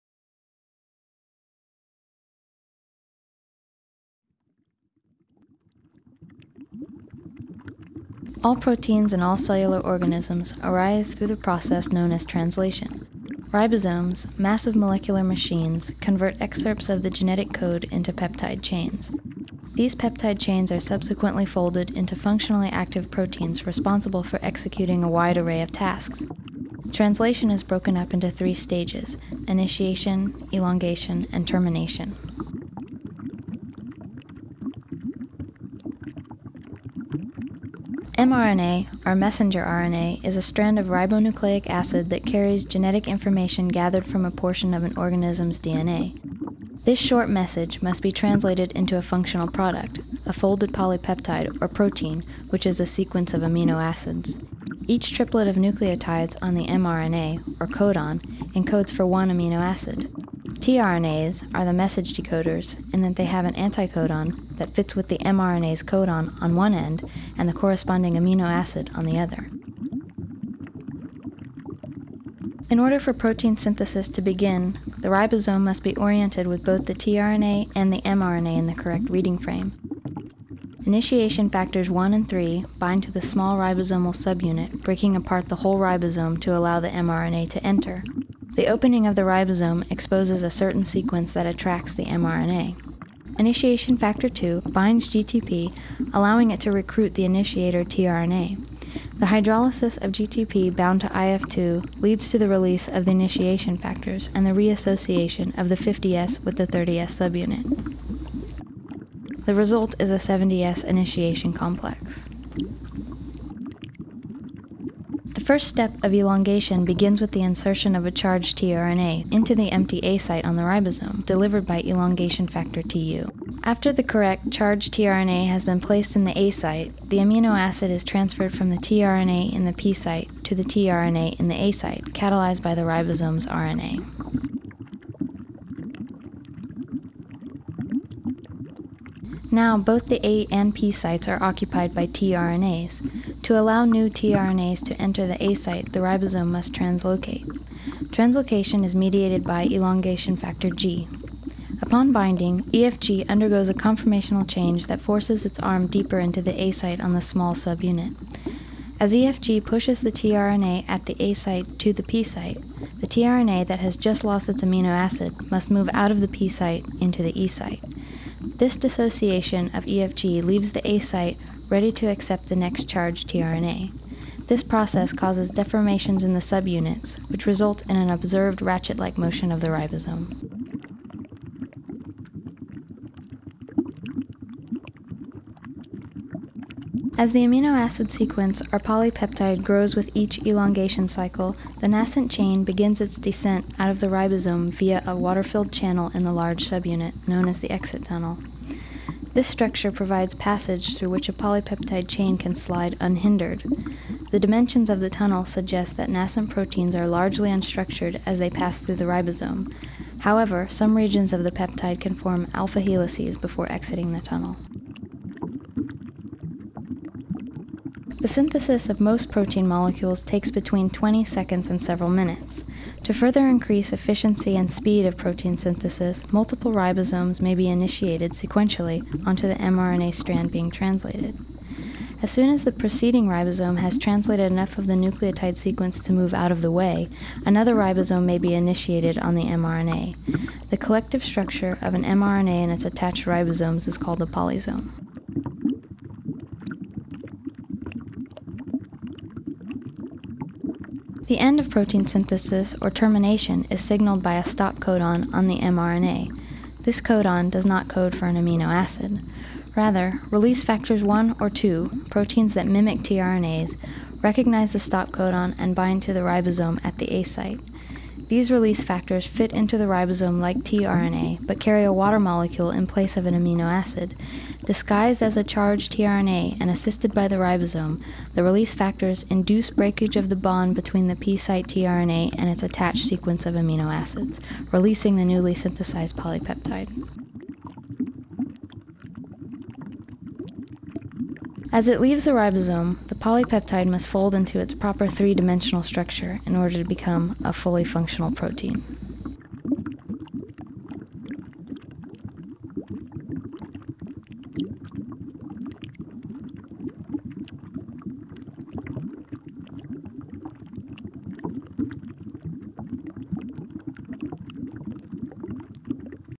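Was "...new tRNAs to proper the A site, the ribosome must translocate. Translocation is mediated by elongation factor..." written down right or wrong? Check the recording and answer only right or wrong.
wrong.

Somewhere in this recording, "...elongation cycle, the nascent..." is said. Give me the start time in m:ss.
3:10.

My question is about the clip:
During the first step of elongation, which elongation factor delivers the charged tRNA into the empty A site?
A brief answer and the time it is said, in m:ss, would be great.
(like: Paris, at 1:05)
elongation factor TU, at 2:01.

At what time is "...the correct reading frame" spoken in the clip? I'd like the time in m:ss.
1:18.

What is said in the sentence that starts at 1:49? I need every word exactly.
The result is a 70S initiation complex.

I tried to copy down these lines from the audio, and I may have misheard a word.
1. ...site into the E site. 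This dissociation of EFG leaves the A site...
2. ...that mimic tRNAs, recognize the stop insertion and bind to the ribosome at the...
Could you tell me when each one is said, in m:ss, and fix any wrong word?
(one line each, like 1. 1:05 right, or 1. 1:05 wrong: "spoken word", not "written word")
1. 2:46 right
2. 4:22 wrong: "codon", not "insertion".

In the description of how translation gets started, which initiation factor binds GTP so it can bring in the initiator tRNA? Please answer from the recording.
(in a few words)
Initiation factor 2.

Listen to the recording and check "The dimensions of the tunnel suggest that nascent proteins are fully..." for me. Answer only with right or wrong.
wrong.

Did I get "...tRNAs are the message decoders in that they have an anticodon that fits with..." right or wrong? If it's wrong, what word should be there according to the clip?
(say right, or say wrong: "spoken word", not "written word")
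right.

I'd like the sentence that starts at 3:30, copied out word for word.
However, some regions of the peptide can form alpha helices before exiting the tunnel.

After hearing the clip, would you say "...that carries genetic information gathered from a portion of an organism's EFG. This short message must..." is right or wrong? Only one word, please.
wrong.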